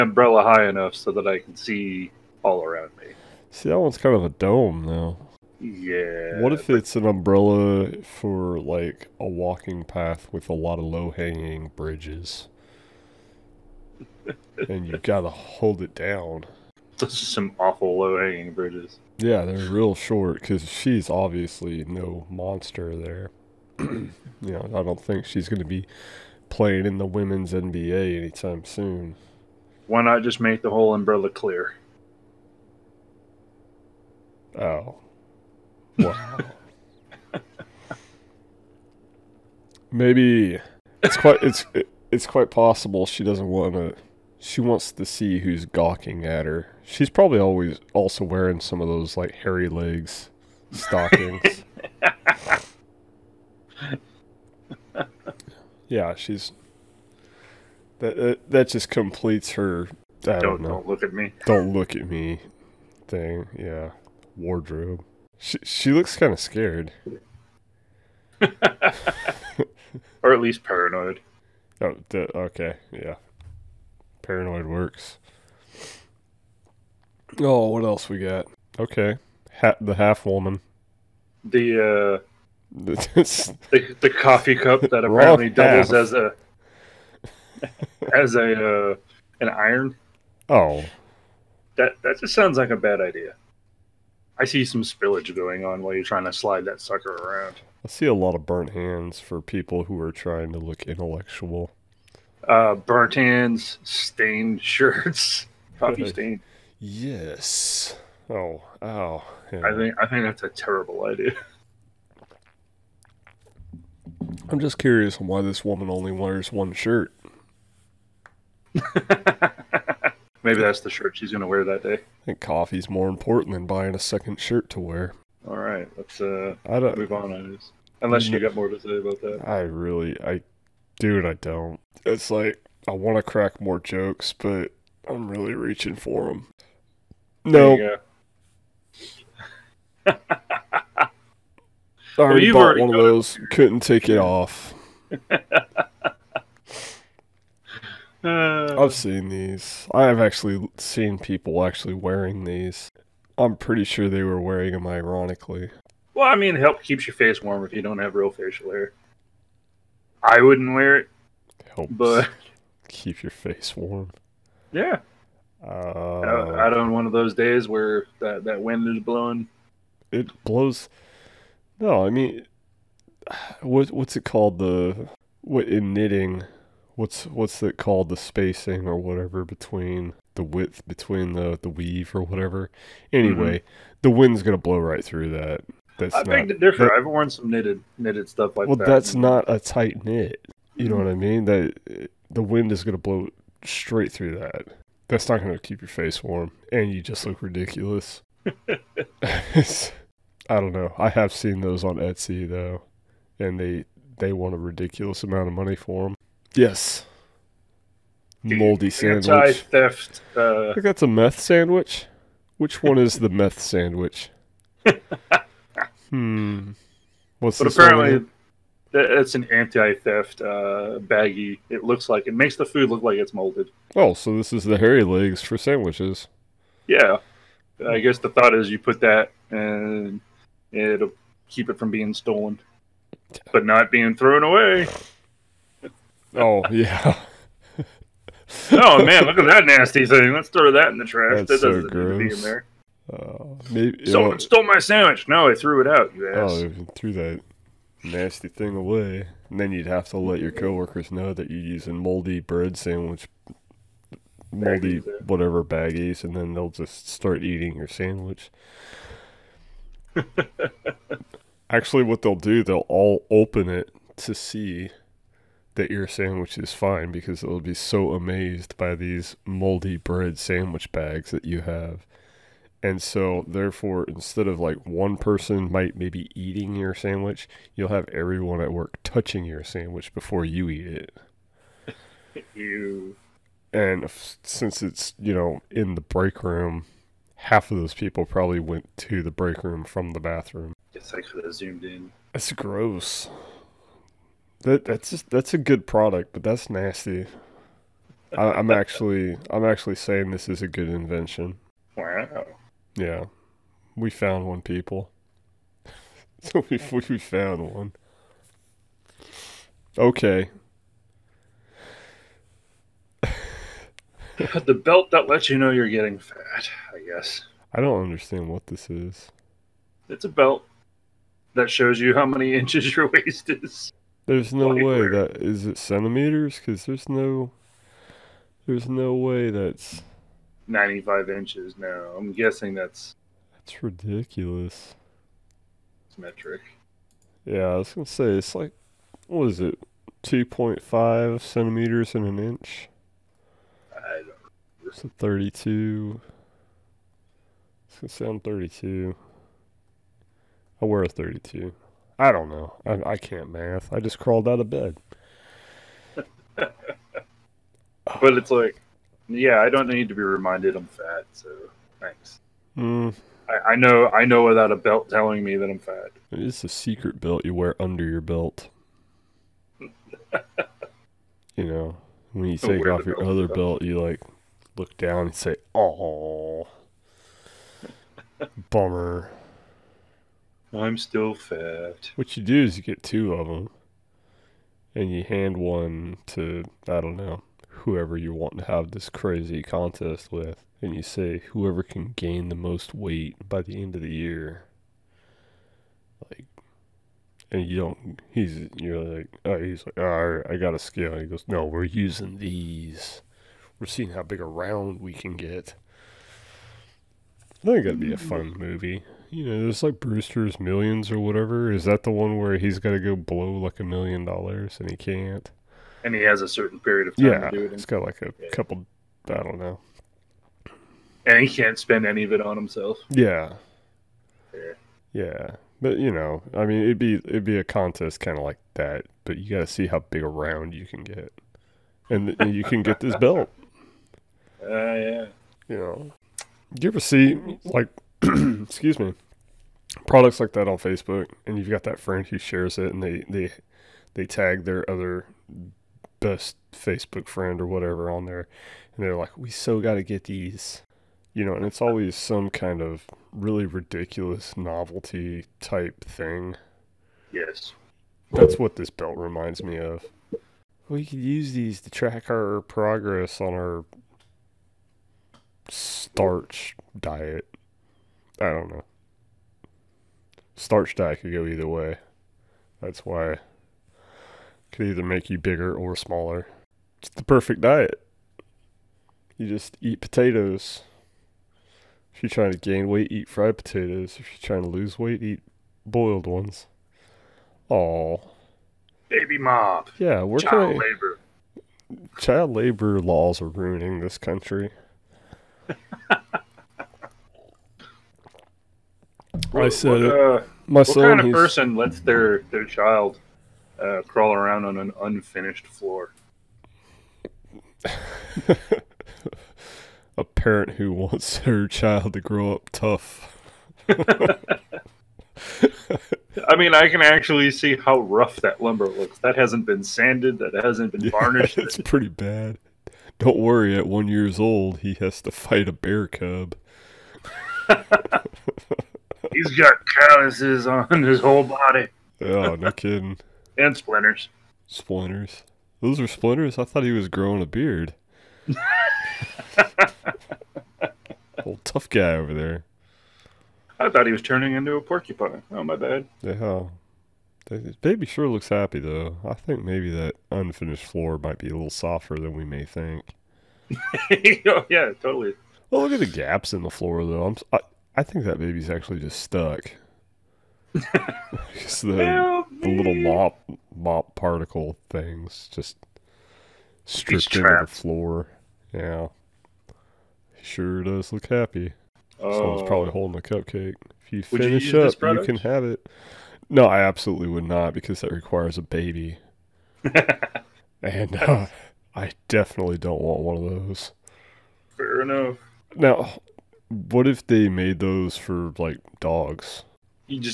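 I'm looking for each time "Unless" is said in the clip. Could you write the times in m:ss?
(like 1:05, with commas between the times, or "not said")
2:08.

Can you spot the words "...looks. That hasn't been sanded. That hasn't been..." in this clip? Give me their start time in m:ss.
8:38.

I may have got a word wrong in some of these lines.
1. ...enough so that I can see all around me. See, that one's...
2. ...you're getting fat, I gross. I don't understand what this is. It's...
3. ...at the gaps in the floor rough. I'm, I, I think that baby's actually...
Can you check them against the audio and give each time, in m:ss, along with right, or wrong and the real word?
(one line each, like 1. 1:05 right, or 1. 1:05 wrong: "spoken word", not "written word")
1. 0:00 right
2. 5:15 wrong: "guess", not "gross"
3. 9:15 wrong: "though", not "rough".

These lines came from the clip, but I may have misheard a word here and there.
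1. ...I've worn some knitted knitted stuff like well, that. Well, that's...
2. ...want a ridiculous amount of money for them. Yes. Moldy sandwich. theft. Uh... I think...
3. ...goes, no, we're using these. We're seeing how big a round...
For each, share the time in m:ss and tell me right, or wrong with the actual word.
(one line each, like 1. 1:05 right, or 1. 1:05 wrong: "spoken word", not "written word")
1. 3:06 right
2. 3:24 right
3. 6:41 right.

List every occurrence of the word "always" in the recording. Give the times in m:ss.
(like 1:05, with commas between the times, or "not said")
0:47, 7:31.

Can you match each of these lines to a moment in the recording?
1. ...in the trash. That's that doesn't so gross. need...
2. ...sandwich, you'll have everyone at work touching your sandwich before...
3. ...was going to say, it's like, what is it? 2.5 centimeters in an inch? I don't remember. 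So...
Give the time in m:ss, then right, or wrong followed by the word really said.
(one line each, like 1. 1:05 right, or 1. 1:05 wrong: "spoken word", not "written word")
1. 4:00 right
2. 4:36 right
3. 5:37 right.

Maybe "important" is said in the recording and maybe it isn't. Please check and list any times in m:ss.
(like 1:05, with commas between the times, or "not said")
2:03.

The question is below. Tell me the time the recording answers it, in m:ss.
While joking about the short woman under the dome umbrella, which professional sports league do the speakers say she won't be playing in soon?
0:27.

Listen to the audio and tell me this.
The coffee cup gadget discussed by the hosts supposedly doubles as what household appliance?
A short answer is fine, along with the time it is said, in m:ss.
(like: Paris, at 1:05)
an iron, at 1:29.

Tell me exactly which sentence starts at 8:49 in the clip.
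He's got calluses on his whole body.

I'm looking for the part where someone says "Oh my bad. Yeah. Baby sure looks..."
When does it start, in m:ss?
9:05.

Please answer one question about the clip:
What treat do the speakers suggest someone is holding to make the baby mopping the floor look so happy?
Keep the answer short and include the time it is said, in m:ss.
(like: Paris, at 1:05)
a cupcake, at 9:33.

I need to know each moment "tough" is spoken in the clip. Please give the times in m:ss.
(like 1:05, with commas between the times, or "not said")
8:32, 9:01.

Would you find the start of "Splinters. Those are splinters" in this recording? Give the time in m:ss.
8:54.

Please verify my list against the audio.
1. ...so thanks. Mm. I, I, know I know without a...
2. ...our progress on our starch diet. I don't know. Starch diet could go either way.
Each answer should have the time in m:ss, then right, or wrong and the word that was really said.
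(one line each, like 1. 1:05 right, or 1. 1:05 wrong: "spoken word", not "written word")
1. 6:01 right
2. 7:42 right.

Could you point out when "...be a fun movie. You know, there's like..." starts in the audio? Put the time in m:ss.
6:47.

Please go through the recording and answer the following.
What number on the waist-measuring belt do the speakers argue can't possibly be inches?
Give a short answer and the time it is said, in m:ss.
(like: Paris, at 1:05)
95, at 5:30.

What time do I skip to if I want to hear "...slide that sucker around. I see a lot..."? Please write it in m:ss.
1:36.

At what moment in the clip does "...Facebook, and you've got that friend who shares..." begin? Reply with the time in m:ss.
7:20.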